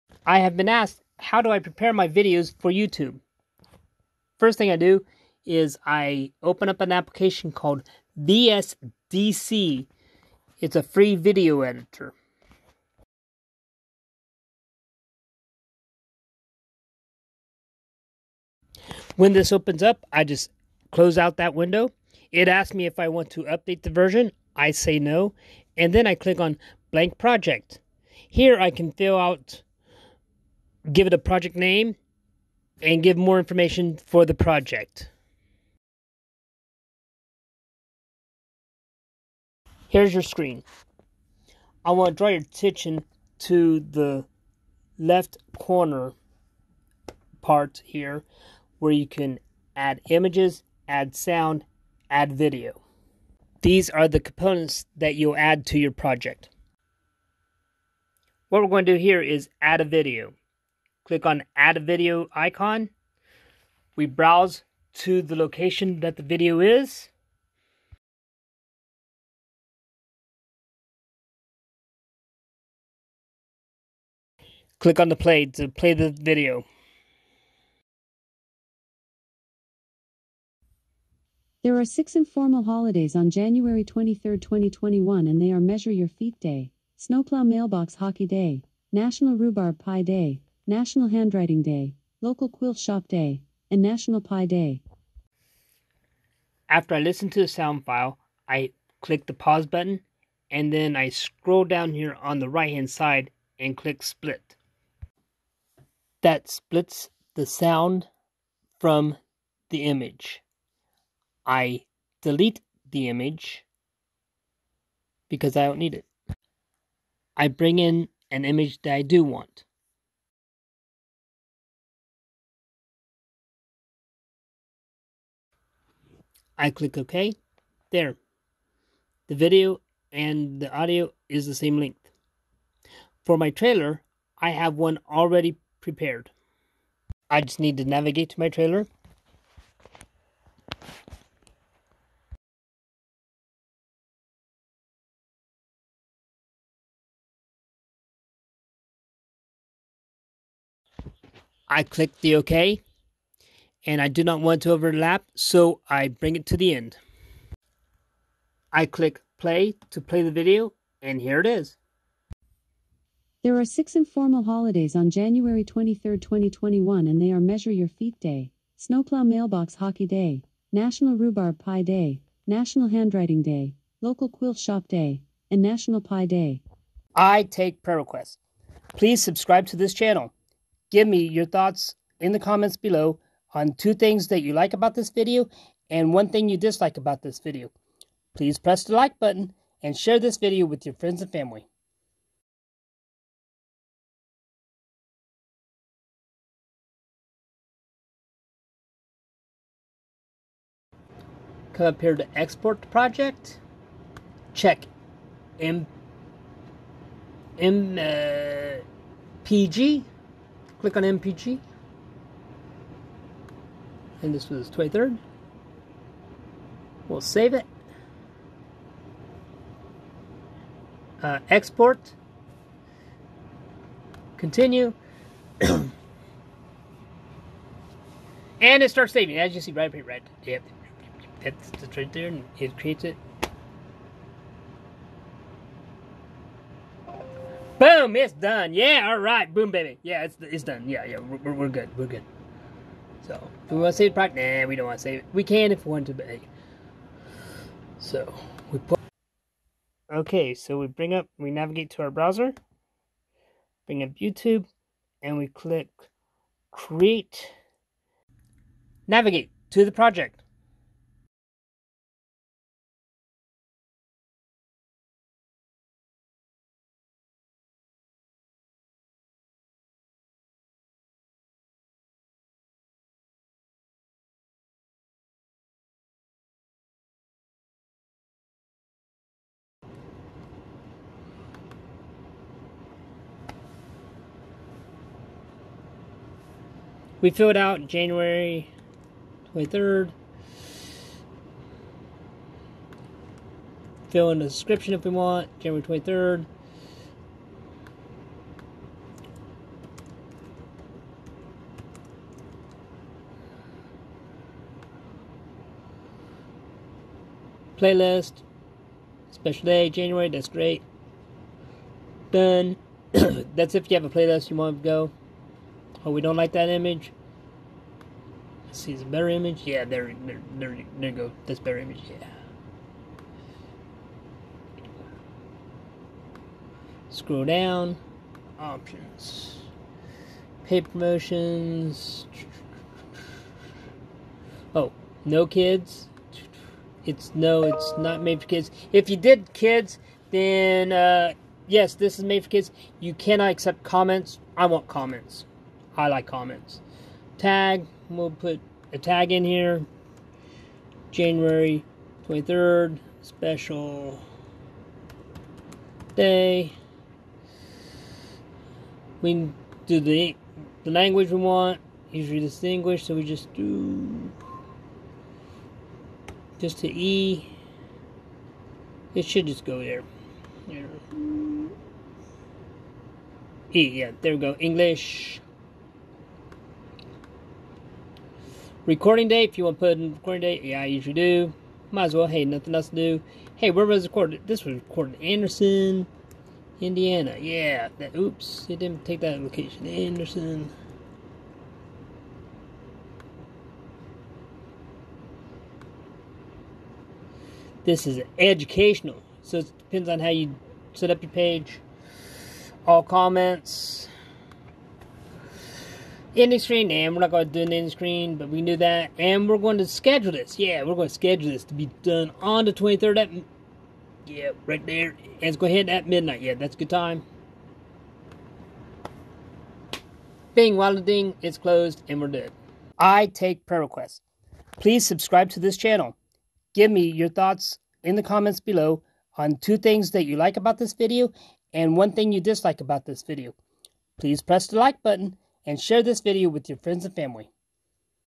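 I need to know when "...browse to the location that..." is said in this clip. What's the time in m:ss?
1:04.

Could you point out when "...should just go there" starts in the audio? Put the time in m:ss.
6:09.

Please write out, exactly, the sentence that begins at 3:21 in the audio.
Come up here to export project.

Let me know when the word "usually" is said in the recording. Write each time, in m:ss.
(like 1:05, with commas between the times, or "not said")
6:02, 6:20.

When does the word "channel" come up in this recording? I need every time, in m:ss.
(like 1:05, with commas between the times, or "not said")
2:59, 7:05.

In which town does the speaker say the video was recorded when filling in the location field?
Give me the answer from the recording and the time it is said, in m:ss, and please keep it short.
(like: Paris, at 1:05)
Anderson, Indiana, at 6:25.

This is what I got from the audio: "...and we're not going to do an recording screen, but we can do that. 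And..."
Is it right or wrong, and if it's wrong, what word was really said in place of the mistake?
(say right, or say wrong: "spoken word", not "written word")
wrong: "ending", not "recording".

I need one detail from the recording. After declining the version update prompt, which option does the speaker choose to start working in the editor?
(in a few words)
blank project.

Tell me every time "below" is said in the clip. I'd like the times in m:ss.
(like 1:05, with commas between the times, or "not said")
3:02, 7:08.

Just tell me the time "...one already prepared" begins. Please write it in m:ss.
2:14.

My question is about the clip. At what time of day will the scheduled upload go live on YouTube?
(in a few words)
midnight.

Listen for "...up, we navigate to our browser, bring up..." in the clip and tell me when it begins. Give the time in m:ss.
4:11.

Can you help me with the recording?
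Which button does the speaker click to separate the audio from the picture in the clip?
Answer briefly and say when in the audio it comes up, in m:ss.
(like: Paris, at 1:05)
split, at 1:44.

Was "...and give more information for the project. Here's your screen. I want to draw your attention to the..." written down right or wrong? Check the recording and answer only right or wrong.
right.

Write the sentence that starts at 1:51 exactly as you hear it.
I delete the image because I don't need it.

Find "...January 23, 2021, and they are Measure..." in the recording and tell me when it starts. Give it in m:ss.
1:23.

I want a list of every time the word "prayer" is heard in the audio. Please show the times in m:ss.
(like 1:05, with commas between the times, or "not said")
2:57, 7:03.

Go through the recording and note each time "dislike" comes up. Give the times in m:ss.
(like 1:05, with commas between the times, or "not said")
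3:06, 7:12.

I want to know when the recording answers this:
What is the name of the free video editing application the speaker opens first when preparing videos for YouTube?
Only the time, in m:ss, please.
0:08.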